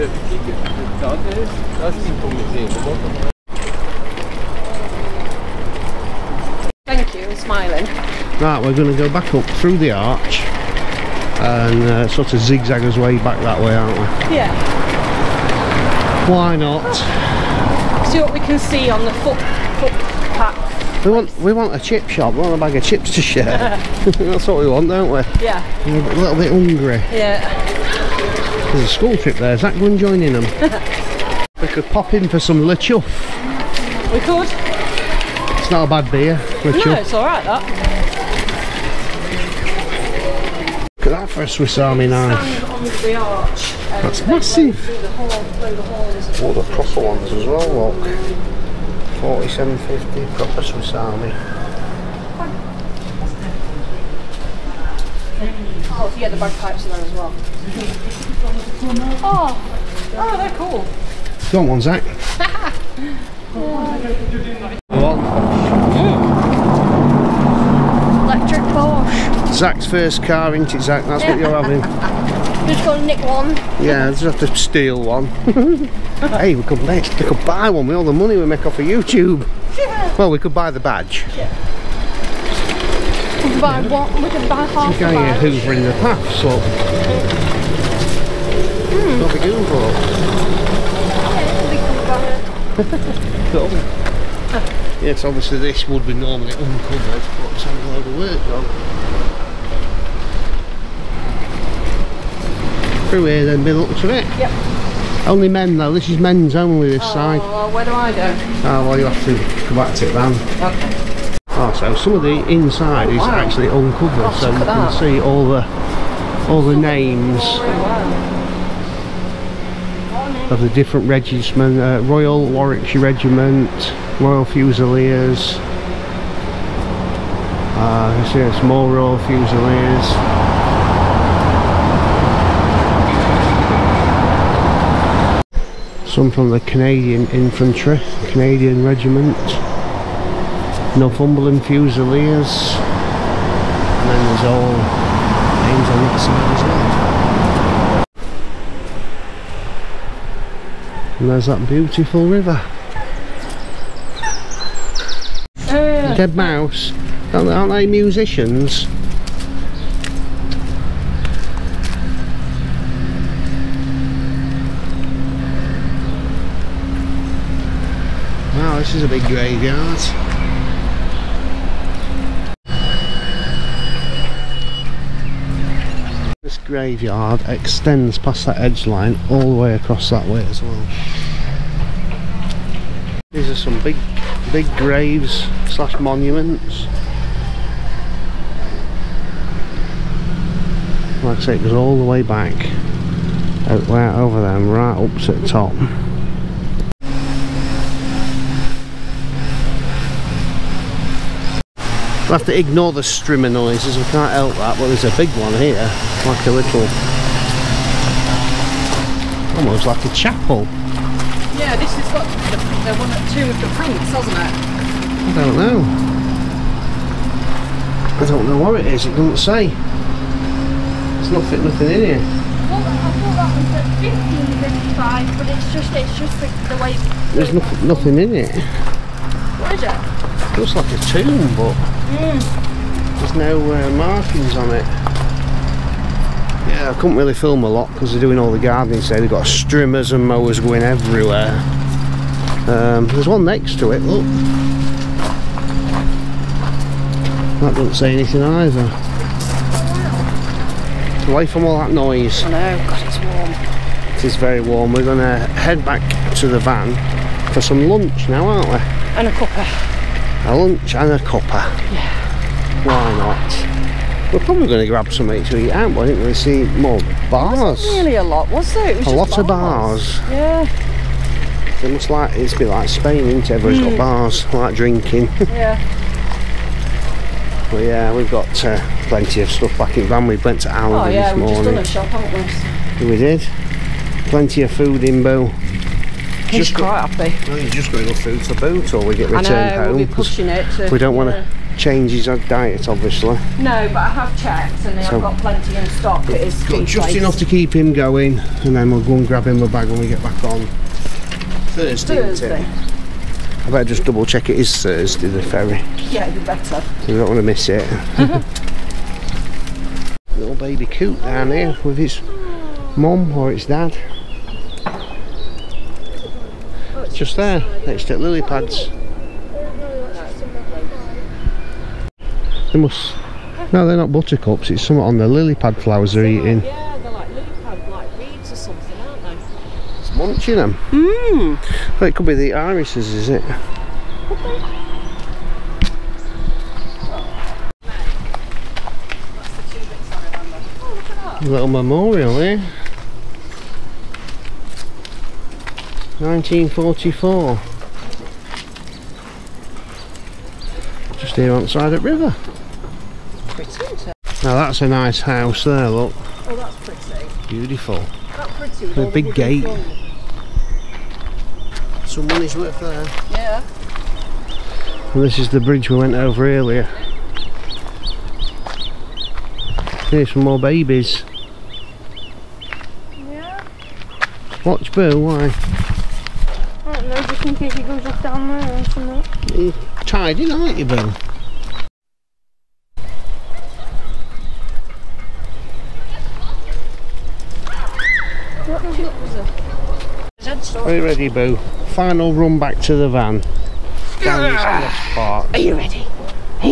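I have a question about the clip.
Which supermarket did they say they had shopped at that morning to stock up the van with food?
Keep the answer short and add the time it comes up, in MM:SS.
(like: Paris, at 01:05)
Aldi, at 04:40.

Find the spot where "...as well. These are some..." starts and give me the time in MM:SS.
03:00.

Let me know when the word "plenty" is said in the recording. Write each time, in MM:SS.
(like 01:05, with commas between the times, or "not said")
04:39, 04:44, 04:55.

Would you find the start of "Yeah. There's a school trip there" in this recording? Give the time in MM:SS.
00:27.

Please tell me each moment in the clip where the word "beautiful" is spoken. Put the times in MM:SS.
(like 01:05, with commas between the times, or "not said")
02:31, 05:57.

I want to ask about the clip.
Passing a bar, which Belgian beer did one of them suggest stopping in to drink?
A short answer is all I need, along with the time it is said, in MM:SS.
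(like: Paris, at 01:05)
La Chouffe, at 00:32.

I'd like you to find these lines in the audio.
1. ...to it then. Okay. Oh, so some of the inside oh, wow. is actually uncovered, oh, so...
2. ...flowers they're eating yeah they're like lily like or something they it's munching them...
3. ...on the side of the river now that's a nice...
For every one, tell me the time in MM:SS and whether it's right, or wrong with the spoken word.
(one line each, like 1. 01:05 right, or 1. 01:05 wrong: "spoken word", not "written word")
1. 01:49 right
2. 05:25 right
3. 05:51 right.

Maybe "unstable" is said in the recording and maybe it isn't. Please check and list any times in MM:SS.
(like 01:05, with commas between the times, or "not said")
not said.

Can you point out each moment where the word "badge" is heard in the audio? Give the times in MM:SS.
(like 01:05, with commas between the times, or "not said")
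01:20, 01:25.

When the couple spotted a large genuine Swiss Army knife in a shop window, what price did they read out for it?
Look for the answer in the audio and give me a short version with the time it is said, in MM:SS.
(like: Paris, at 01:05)
47.50, at 00:49.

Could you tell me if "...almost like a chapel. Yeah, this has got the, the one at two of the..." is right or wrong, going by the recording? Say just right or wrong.
right.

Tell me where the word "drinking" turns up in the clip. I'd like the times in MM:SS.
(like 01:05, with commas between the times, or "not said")
04:34.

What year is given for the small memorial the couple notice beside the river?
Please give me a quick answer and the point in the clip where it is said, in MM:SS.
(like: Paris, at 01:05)
1944, at 05:46.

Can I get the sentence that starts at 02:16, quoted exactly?
some from the Canadian Infantry, Canadian Regiment, Northumberland Fusiliers, and then there's all names on the other side as well.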